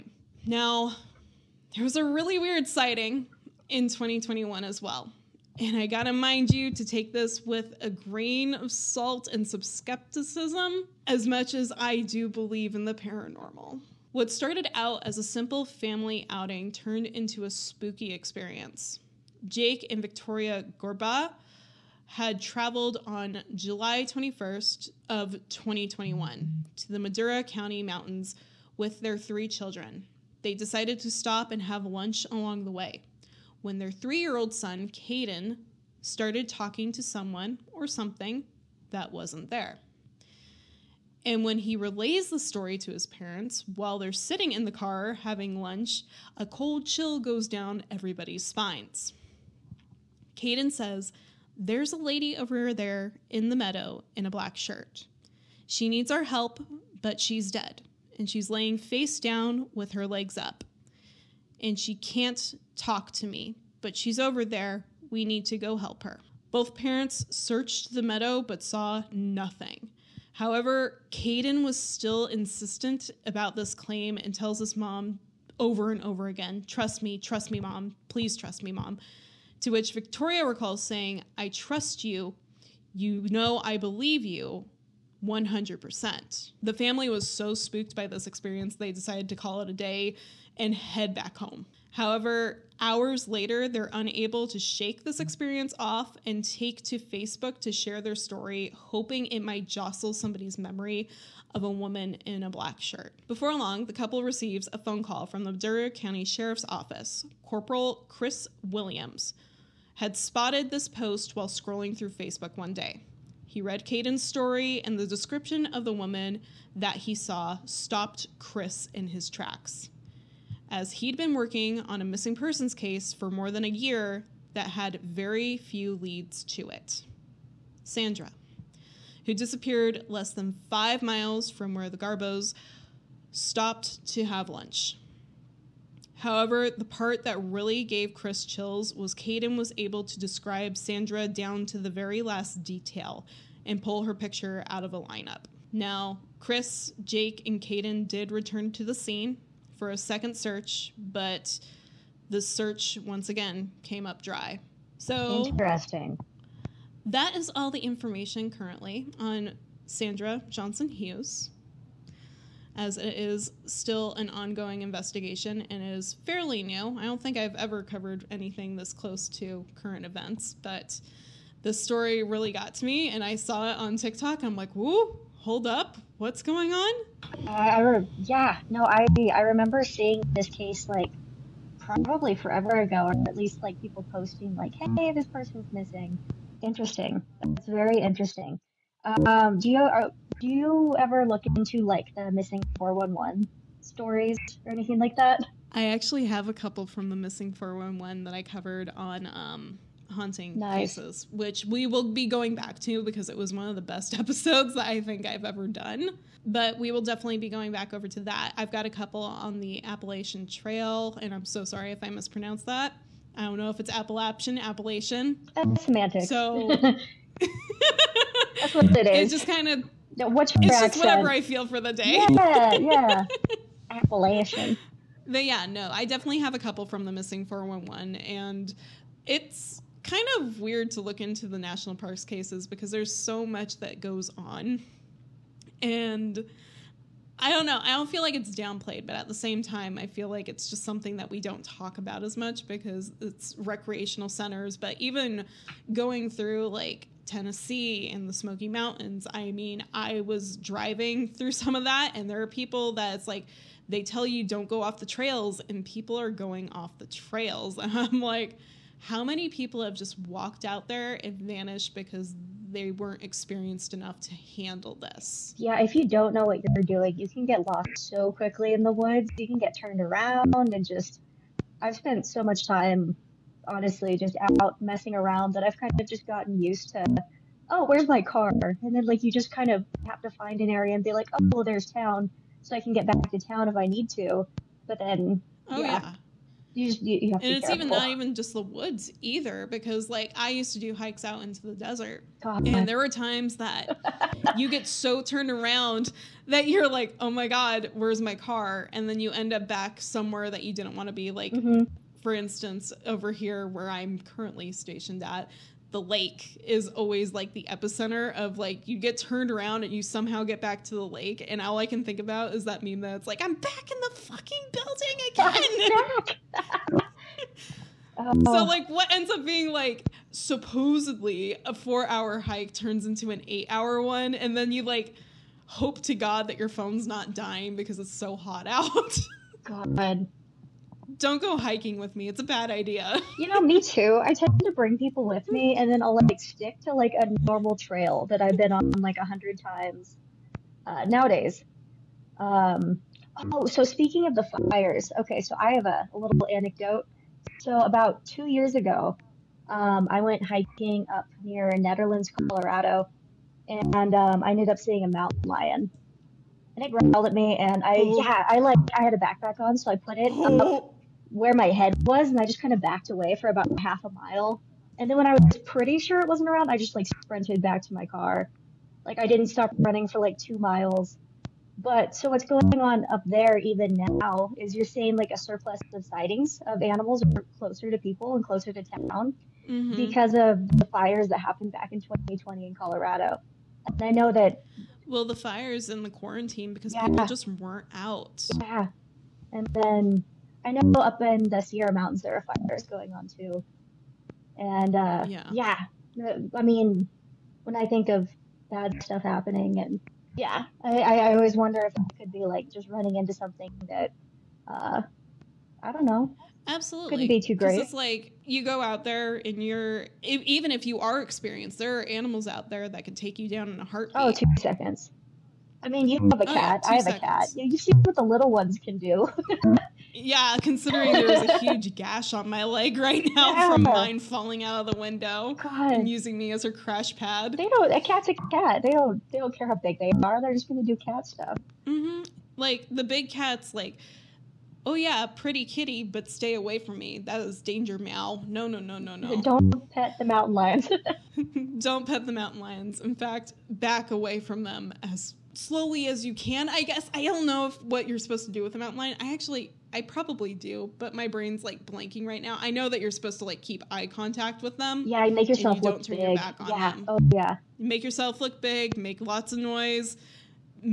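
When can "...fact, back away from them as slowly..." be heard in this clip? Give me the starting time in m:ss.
7:23.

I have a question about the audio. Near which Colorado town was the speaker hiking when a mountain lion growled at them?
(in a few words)
Nederland.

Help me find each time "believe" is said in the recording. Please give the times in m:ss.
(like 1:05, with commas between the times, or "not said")
0:12, 1:23.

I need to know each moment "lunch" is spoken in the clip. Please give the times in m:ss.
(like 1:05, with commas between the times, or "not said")
0:31, 0:45, 2:14.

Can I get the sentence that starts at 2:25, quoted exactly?
Now, Chris, Jake, and Caden did return to the scene for a second search, but the search once again came up dry.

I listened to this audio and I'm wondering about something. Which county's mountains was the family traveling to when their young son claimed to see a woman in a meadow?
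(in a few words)
Madera County.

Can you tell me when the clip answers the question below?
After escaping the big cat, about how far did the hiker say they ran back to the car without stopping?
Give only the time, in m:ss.
6:10.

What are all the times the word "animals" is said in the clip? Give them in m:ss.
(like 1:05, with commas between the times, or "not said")
6:16, 6:52.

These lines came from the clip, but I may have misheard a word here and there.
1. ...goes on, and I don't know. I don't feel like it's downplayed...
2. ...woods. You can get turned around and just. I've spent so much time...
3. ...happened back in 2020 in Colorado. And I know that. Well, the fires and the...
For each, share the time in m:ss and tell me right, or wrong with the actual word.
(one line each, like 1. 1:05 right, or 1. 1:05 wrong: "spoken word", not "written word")
1. 3:54 right
2. 4:28 right
3. 6:21 right.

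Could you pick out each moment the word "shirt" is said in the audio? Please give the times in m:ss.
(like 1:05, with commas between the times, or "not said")
0:54, 1:42.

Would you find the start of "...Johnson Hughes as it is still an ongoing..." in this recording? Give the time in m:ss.
2:40.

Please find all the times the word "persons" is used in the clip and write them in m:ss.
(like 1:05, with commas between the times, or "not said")
2:02, 3:05.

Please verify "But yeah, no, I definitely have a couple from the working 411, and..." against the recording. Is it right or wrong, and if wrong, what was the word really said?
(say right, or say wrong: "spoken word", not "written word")
wrong: "missing", not "working".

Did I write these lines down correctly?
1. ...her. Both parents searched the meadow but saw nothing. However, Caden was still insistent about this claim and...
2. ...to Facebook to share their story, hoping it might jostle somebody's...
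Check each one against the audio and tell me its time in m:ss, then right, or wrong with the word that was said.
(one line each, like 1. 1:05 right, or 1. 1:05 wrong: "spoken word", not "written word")
1. 1:06 right
2. 1:36 right.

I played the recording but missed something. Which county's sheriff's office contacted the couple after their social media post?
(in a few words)
Ventura County.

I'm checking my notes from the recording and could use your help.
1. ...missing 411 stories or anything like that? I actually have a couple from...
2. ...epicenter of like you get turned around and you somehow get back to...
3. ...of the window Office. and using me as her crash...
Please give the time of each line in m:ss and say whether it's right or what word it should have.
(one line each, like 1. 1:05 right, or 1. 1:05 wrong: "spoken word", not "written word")
1. 3:12 right
2. 5:07 right
3. 7:04 wrong: "God", not "Office".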